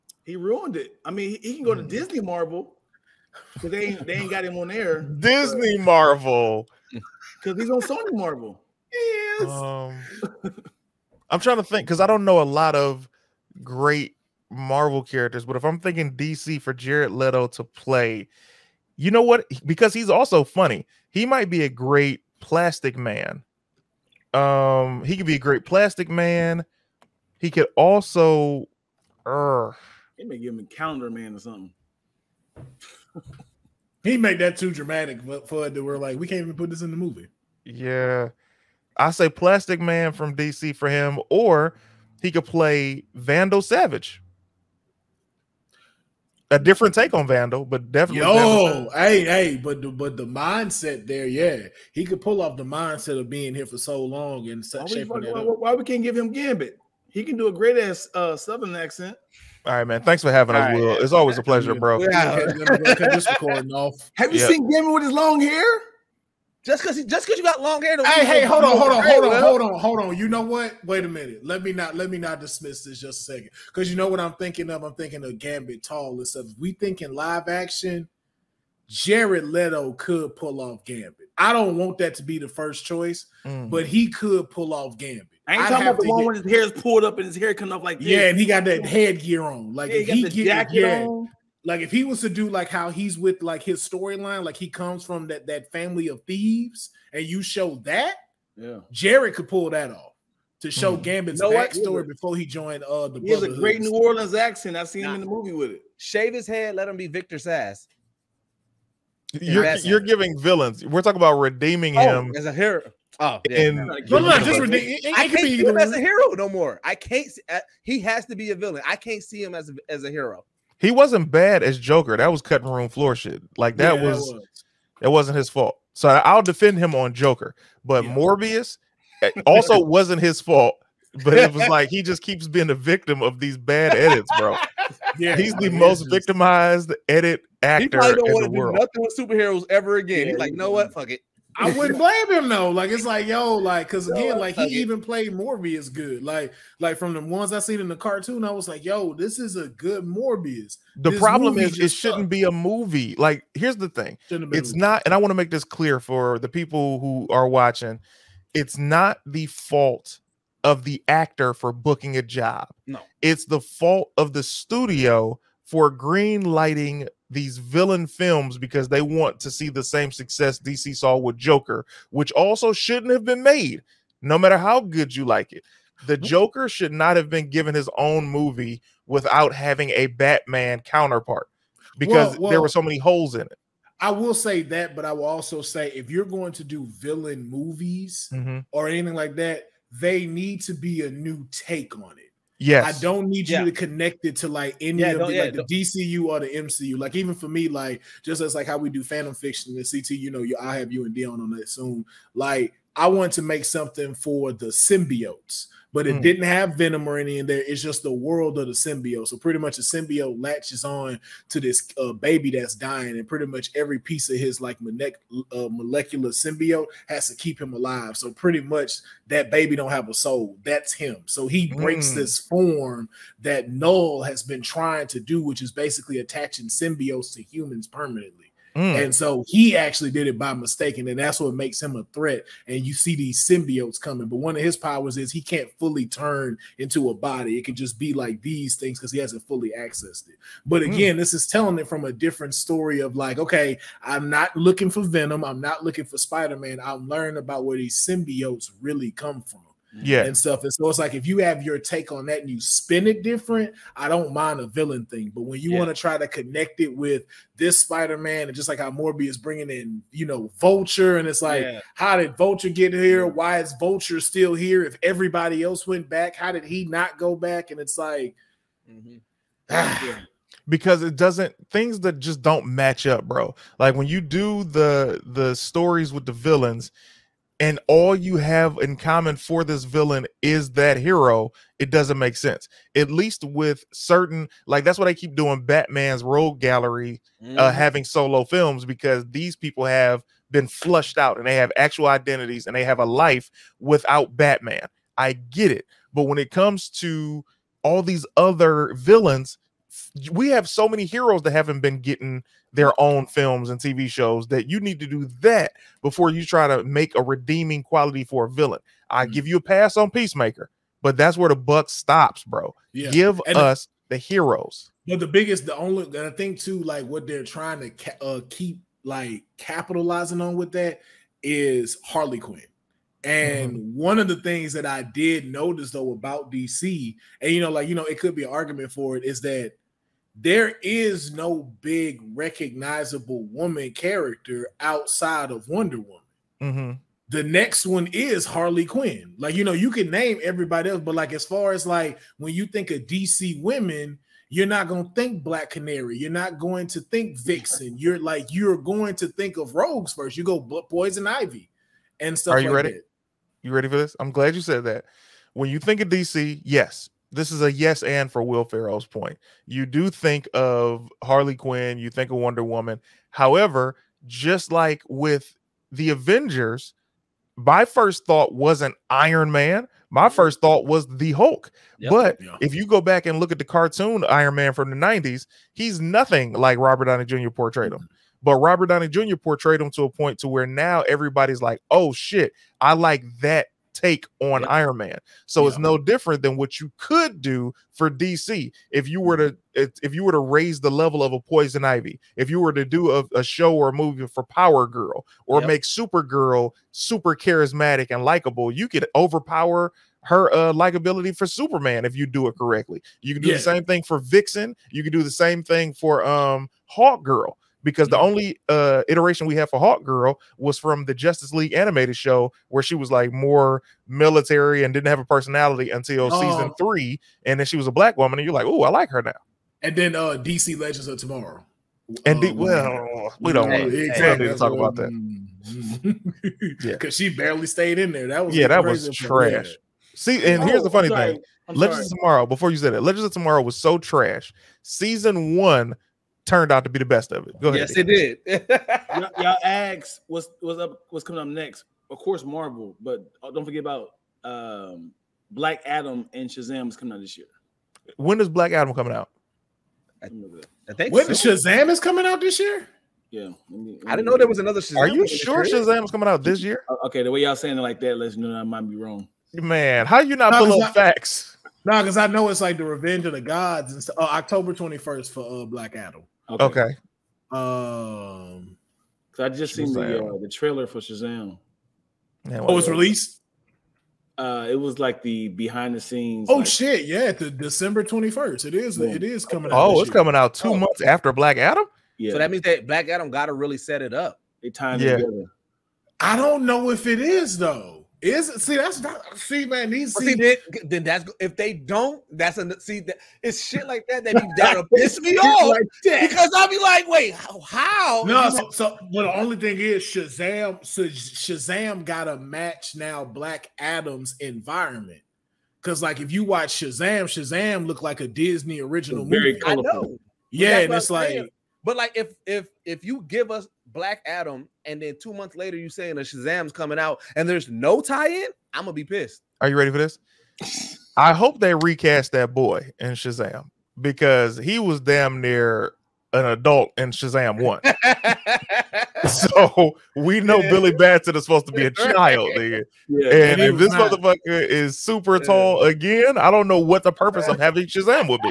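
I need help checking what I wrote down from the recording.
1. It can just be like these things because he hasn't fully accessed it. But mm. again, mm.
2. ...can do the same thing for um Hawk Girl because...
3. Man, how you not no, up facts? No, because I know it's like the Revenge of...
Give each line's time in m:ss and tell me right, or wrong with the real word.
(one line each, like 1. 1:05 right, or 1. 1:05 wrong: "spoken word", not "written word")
1. 3:57 right
2. 6:45 right
3. 7:39 right.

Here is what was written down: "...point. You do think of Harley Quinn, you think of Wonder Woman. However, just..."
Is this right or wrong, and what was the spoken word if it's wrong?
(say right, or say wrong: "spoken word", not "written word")
right.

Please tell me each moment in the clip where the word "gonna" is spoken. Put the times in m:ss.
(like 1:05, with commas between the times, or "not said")
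8:38.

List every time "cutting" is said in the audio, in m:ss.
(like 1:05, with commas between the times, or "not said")
2:02.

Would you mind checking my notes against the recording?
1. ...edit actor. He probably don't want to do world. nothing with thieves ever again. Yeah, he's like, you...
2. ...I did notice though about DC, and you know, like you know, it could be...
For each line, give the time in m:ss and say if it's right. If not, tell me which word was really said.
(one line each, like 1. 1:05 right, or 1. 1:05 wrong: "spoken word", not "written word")
1. 2:17 wrong: "superheroes", not "thieves"
2. 5:24 right.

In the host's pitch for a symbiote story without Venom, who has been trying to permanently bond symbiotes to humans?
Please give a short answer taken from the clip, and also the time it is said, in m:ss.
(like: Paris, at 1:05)
Knull, at 3:43.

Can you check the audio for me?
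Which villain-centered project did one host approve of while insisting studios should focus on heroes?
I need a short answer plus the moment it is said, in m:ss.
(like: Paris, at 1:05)
Peacemaker, at 5:10.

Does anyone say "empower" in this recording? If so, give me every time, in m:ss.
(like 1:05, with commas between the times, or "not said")
not said.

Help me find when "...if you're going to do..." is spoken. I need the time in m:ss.
3:05.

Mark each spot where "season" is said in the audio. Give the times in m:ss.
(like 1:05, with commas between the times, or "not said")
6:56, 7:14.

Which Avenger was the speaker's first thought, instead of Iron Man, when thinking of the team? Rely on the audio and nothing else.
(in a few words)
the Hulk.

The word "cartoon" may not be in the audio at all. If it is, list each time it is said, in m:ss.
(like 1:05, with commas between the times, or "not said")
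2:27, 6:13.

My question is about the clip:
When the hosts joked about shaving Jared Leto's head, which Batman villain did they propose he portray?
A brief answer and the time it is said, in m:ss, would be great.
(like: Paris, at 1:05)
Victor Zsasz, at 1:47.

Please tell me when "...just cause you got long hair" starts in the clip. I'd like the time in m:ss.
1:07.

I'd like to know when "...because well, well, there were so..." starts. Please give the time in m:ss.
3:01.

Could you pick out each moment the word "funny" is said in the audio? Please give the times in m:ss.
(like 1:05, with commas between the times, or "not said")
0:20, 7:10.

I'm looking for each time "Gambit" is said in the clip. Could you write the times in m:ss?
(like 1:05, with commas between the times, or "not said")
0:56, 1:15, 1:20, 1:24, 1:41.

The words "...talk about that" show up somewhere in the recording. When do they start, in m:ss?
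7:04.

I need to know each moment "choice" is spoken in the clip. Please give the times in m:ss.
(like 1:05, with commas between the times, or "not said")
1:22.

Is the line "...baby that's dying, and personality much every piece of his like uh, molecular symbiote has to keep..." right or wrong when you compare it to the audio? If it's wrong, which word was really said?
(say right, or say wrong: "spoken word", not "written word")
wrong: "pretty", not "personality".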